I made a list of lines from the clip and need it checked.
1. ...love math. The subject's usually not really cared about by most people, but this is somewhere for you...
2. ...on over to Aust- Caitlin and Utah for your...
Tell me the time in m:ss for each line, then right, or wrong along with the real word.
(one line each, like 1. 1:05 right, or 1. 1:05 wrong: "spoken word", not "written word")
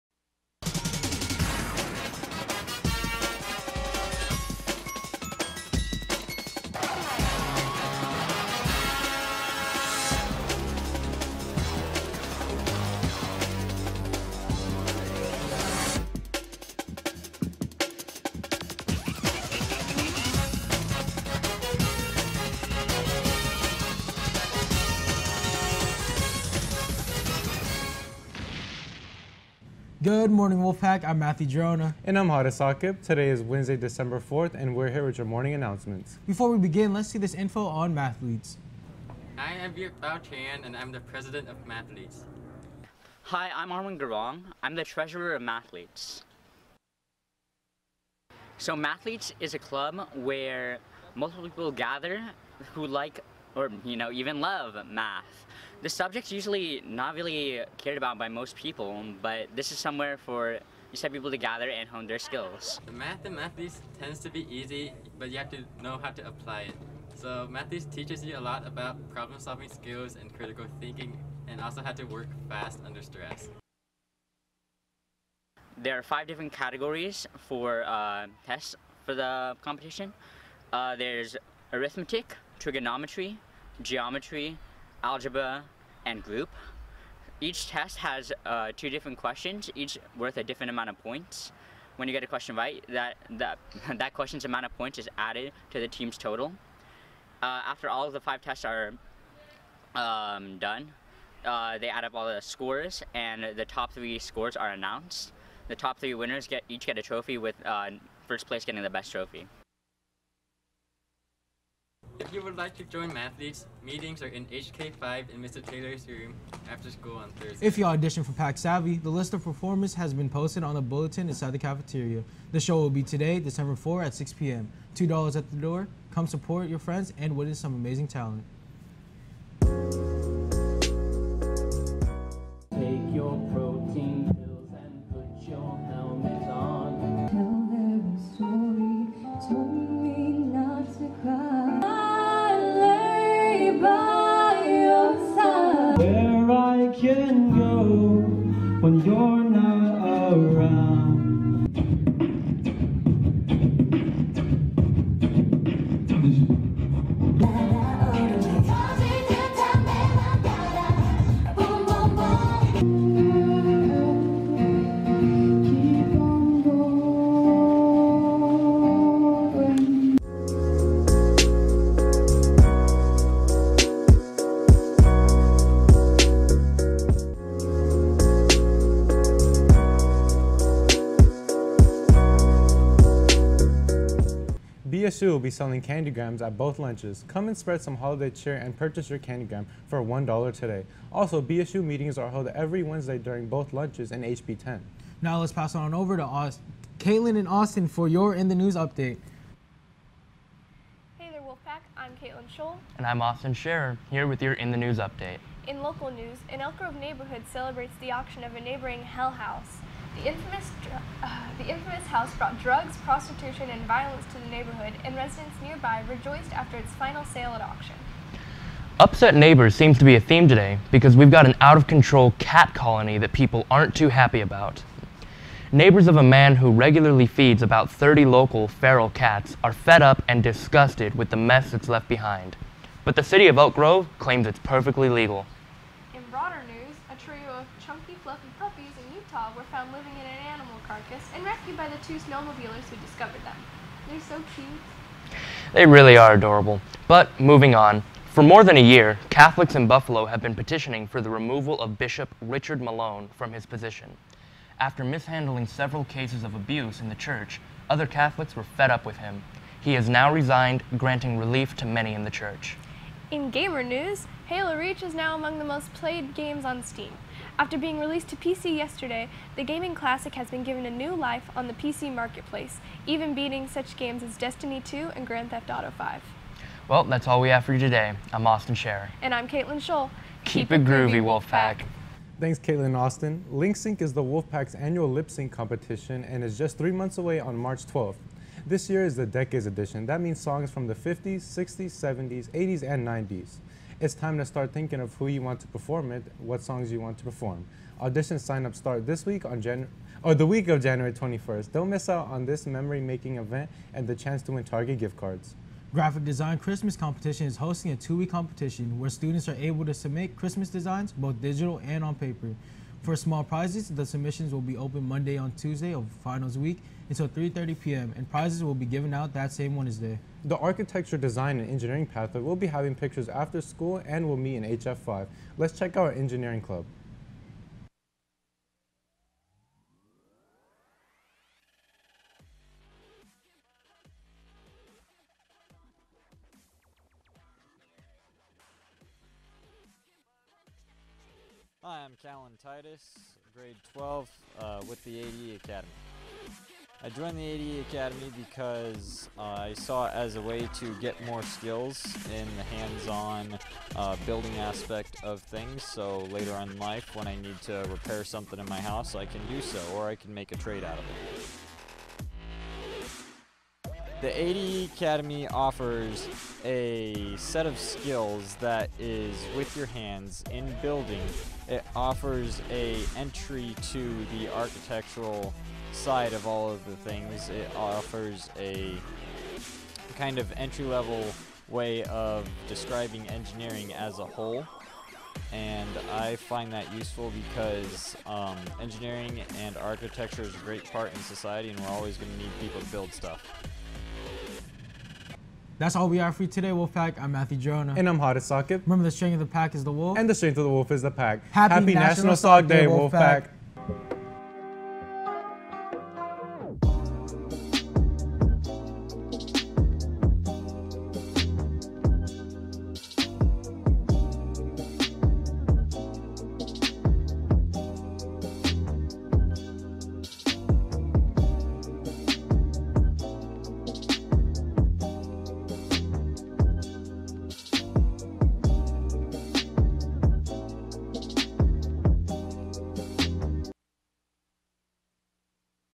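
1. 0:54 right
2. 3:15 wrong: "Austin", not "Utah".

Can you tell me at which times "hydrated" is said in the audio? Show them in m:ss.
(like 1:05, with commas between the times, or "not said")
not said.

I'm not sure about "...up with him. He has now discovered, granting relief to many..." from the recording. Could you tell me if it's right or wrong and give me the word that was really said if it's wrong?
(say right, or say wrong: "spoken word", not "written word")
wrong: "resigned", not "discovered".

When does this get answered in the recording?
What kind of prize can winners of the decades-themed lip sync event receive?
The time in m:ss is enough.
5:04.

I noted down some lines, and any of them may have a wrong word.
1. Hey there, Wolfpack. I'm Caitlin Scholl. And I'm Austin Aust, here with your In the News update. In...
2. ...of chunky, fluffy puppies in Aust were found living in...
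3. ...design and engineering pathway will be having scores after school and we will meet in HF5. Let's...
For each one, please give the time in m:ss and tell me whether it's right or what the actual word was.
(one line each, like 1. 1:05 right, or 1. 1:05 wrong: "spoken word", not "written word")
1. 3:21 wrong: "Scherer", not "Aust"
2. 3:57 wrong: "Utah", not "Aust"
3. 5:21 wrong: "pictures", not "scores".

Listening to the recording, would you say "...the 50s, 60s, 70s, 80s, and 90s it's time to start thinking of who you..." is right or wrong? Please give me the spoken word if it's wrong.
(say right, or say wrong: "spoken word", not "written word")
right.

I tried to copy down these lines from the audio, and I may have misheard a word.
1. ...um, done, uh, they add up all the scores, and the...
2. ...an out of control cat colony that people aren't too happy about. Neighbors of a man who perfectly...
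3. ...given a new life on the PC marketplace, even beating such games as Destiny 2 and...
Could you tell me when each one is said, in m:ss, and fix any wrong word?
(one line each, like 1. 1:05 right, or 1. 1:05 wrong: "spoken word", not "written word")
1. 1:39 right
2. 3:41 wrong: "regularly", not "perfectly"
3. 4:30 right.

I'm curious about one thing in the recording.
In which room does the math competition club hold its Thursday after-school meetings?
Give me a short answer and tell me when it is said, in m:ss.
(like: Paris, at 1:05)
HK5, at 1:54.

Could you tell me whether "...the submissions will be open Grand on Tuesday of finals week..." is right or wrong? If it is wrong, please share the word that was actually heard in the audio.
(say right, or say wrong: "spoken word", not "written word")
wrong: "Monday", not "Grand".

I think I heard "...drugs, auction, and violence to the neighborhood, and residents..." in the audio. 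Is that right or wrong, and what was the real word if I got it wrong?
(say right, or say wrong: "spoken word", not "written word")
wrong: "prostitution", not "auction".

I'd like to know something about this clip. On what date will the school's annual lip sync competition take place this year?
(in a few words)
March 12th.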